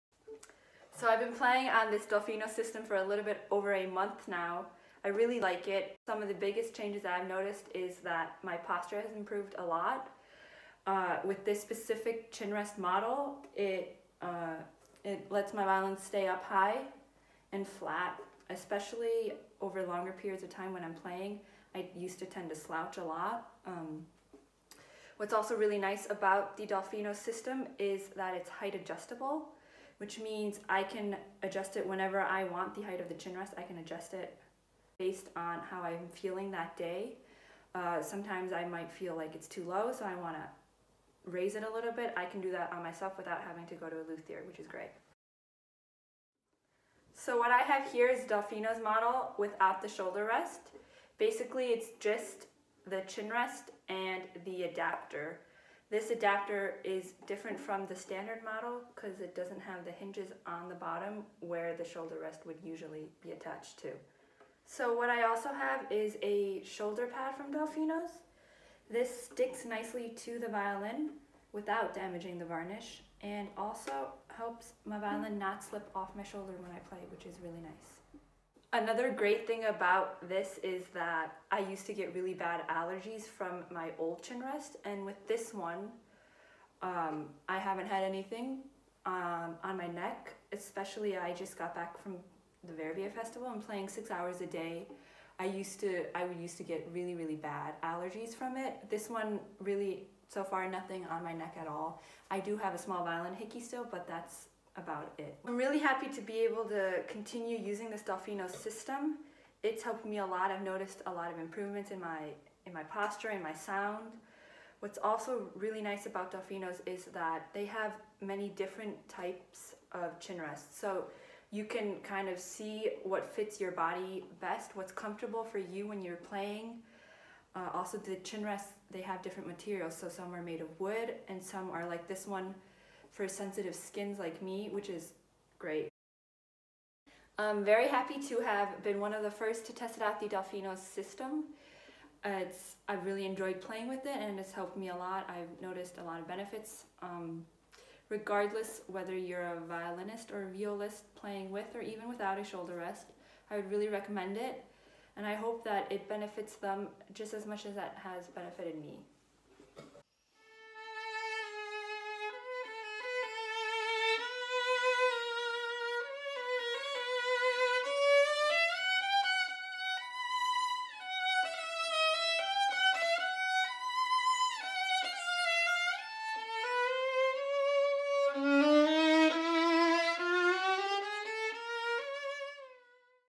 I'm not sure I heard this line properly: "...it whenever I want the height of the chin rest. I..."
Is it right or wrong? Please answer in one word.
right.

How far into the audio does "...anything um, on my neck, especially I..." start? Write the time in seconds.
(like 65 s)
88 s.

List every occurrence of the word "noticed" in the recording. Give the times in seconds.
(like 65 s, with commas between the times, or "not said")
7 s, 110 s, 145 s.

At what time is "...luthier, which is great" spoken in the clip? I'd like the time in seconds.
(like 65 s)
44 s.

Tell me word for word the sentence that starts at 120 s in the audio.
So you can kind of see what fits your body best, what's comfortable for you when you're playing.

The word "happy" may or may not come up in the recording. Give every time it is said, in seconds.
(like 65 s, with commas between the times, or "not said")
105 s, 137 s.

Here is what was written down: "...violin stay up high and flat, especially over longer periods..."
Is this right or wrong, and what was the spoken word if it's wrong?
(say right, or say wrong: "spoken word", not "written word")
right.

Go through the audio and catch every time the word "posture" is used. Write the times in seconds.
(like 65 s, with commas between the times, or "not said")
8 s, 112 s.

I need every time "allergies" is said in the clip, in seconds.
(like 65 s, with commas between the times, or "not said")
82 s, 97 s.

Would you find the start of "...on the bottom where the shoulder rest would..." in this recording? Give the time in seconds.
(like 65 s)
60 s.